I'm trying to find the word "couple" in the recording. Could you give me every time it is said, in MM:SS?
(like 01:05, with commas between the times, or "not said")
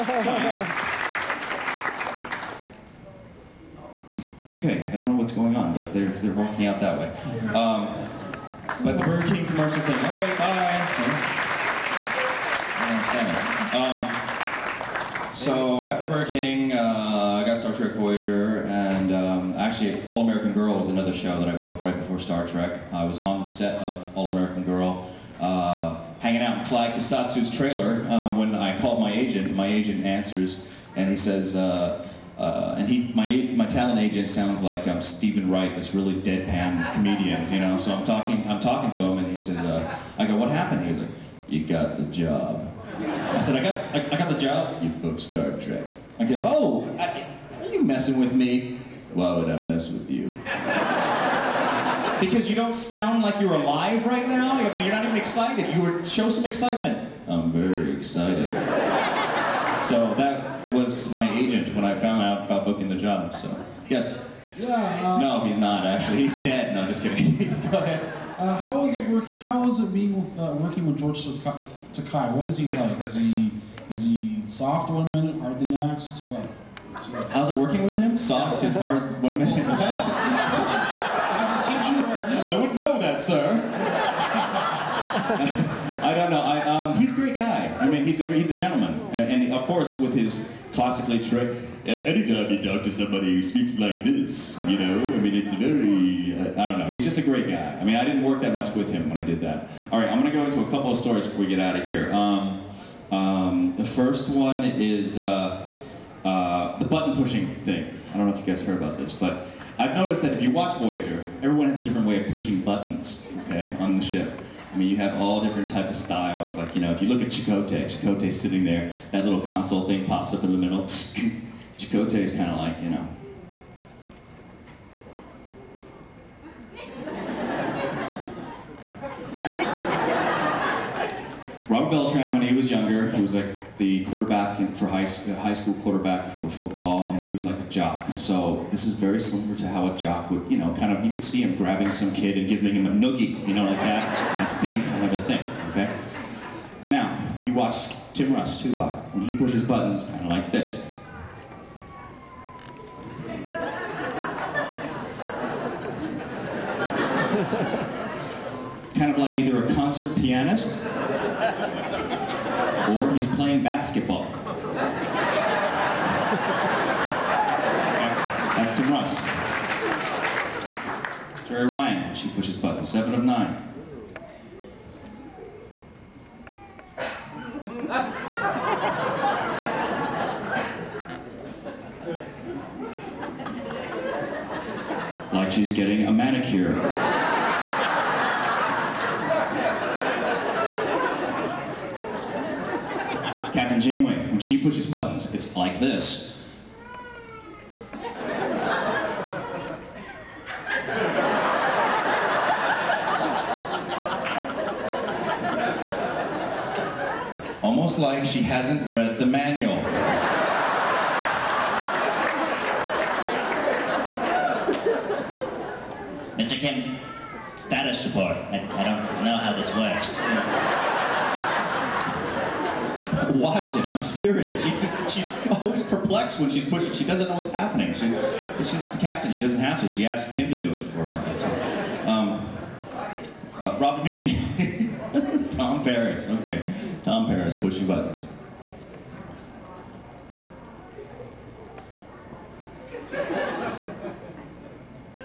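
01:40.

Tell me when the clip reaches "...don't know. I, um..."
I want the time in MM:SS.
01:26.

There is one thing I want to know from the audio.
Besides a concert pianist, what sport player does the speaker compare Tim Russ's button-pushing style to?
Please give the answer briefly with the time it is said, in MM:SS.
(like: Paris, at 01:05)
Basketball, at 02:43.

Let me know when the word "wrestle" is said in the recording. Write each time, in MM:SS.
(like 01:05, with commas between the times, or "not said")
not said.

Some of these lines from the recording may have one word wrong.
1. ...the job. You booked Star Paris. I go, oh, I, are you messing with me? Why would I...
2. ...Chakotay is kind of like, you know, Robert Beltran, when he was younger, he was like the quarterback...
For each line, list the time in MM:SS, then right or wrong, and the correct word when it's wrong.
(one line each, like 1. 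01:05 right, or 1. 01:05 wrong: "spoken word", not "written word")
1. 00:44 wrong: "Trek", not "Paris"
2. 02:01 right.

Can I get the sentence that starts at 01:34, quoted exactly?
I mean, it's very, I don't know.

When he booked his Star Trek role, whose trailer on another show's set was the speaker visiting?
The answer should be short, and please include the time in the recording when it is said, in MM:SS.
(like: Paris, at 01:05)
Clyde Kusatsu, at 00:26.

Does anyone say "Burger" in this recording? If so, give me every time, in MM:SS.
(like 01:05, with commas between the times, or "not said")
00:09, 00:16.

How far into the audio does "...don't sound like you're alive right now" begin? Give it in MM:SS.
00:52.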